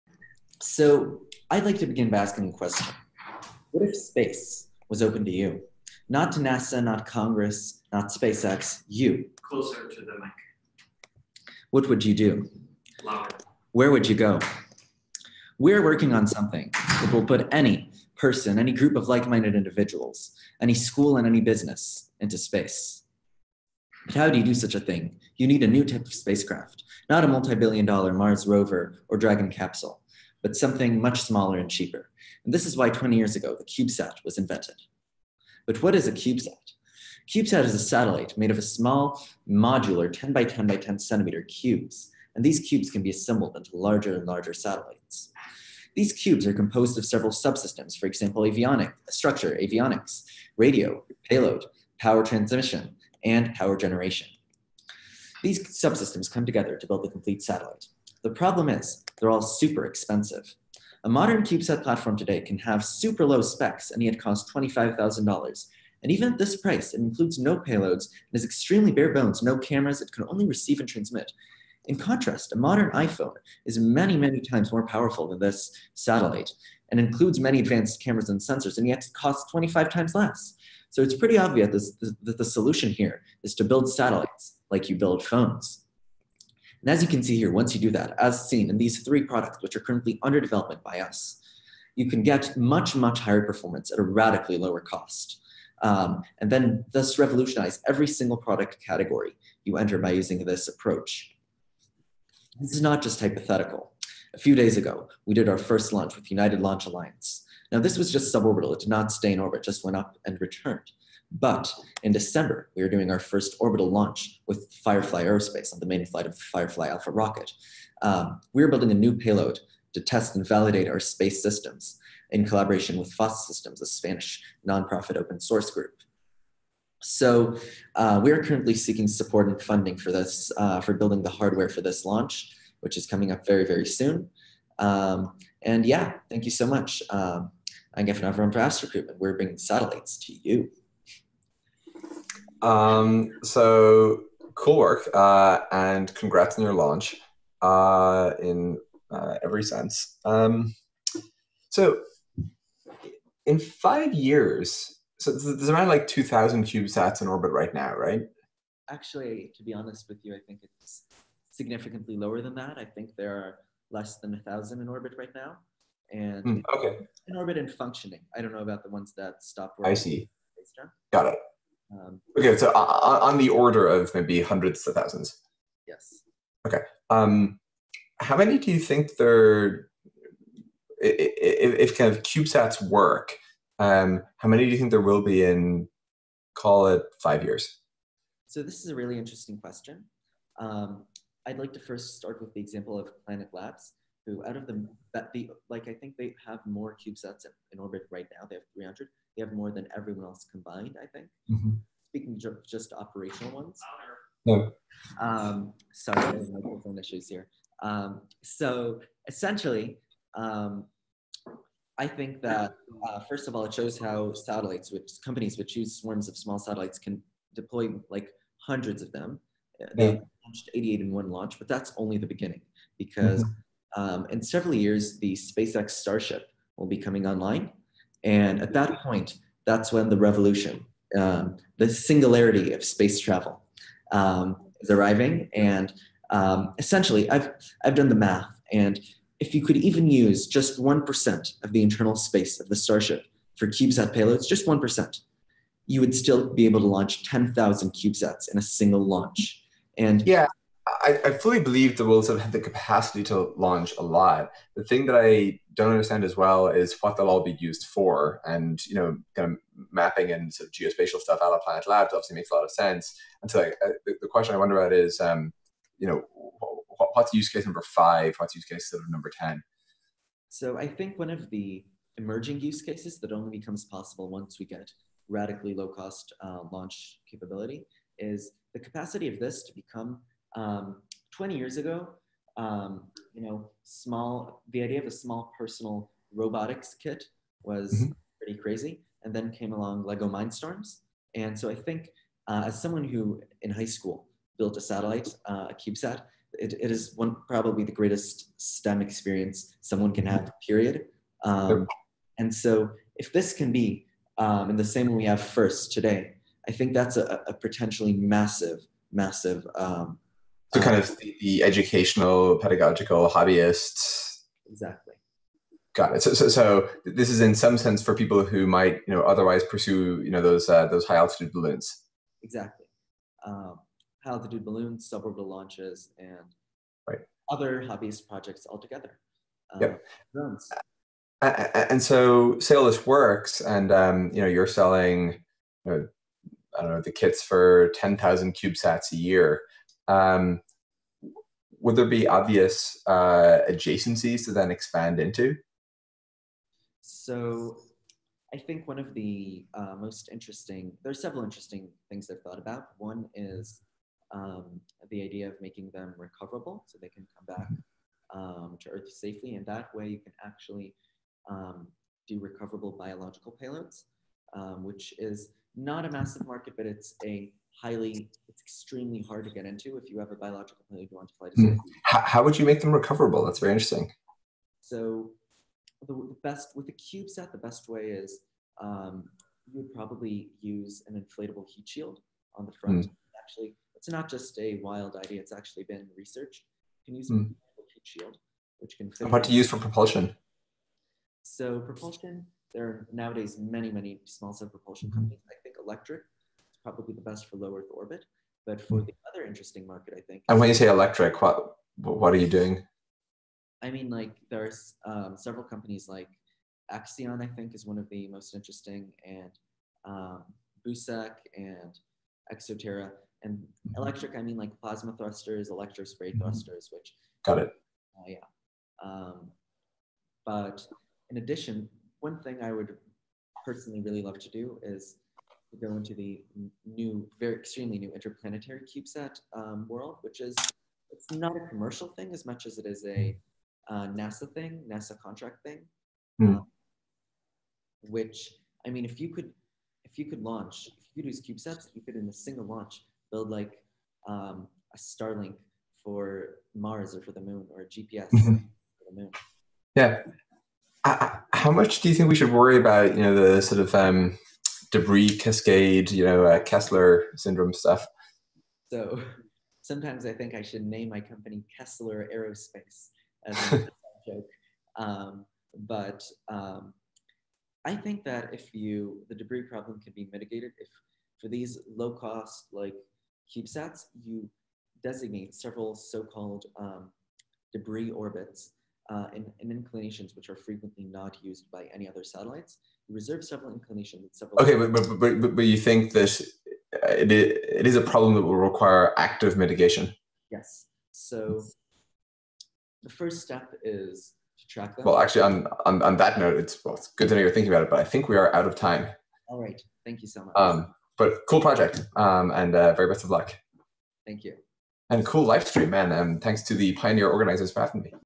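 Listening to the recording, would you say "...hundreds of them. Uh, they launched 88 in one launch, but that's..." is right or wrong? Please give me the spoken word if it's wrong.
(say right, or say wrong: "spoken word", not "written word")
right.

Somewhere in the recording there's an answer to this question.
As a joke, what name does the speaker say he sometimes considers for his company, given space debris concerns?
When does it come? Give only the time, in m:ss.
7:41.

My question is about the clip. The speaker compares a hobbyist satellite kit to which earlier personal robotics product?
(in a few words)
Lego Mindstorms.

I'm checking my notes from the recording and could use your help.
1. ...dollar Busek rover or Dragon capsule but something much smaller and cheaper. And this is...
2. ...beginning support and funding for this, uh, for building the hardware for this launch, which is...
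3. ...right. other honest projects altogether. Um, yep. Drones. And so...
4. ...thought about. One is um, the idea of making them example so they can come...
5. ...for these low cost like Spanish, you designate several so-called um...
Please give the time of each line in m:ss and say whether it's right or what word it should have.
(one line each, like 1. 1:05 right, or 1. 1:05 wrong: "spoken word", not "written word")
1. 0:27 wrong: "Mars", not "Busek"
2. 2:08 wrong: "seeking", not "beginning"
3. 5:27 wrong: "hobbyist", not "honest"
4. 5:52 wrong: "recoverable", not "example"
5. 7:51 wrong: "CubeSats", not "Spanish".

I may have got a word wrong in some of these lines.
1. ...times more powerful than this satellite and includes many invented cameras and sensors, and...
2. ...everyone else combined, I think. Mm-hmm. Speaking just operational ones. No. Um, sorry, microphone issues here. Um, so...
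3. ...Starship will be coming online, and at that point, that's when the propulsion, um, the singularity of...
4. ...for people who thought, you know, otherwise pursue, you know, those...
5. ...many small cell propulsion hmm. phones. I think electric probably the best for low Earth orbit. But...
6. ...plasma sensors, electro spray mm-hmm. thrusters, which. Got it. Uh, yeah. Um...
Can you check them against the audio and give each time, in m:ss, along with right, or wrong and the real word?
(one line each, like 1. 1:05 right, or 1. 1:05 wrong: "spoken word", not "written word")
1. 1:14 wrong: "advanced", not "invented"
2. 3:19 right
3. 3:45 wrong: "revolution", not "propulsion"
4. 5:18 wrong: "might", not "thought"
5. 6:33 wrong: "companies", not "phones"
6. 6:54 wrong: "thrusters", not "sensors".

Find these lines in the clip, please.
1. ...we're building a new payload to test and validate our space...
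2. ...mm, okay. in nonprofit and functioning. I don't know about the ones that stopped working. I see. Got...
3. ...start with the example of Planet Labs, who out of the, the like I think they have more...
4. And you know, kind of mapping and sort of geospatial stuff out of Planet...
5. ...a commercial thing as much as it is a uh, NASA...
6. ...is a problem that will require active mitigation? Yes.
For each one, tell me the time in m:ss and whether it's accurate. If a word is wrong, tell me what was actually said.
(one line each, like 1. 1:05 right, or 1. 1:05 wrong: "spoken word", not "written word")
1. 1:58 right
2. 2:46 wrong: "orbit", not "nonprofit"
3. 3:12 right
4. 4:18 right
5. 7:11 right
6. 8:07 right.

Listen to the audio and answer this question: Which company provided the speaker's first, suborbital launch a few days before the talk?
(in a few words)
United Launch Alliance.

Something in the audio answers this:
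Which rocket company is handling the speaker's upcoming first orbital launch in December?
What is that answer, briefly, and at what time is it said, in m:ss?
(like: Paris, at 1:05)
Firefly Aerospace, at 1:54.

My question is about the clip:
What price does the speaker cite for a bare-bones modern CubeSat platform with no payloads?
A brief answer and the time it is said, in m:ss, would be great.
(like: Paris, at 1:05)
$25,000, at 1:04.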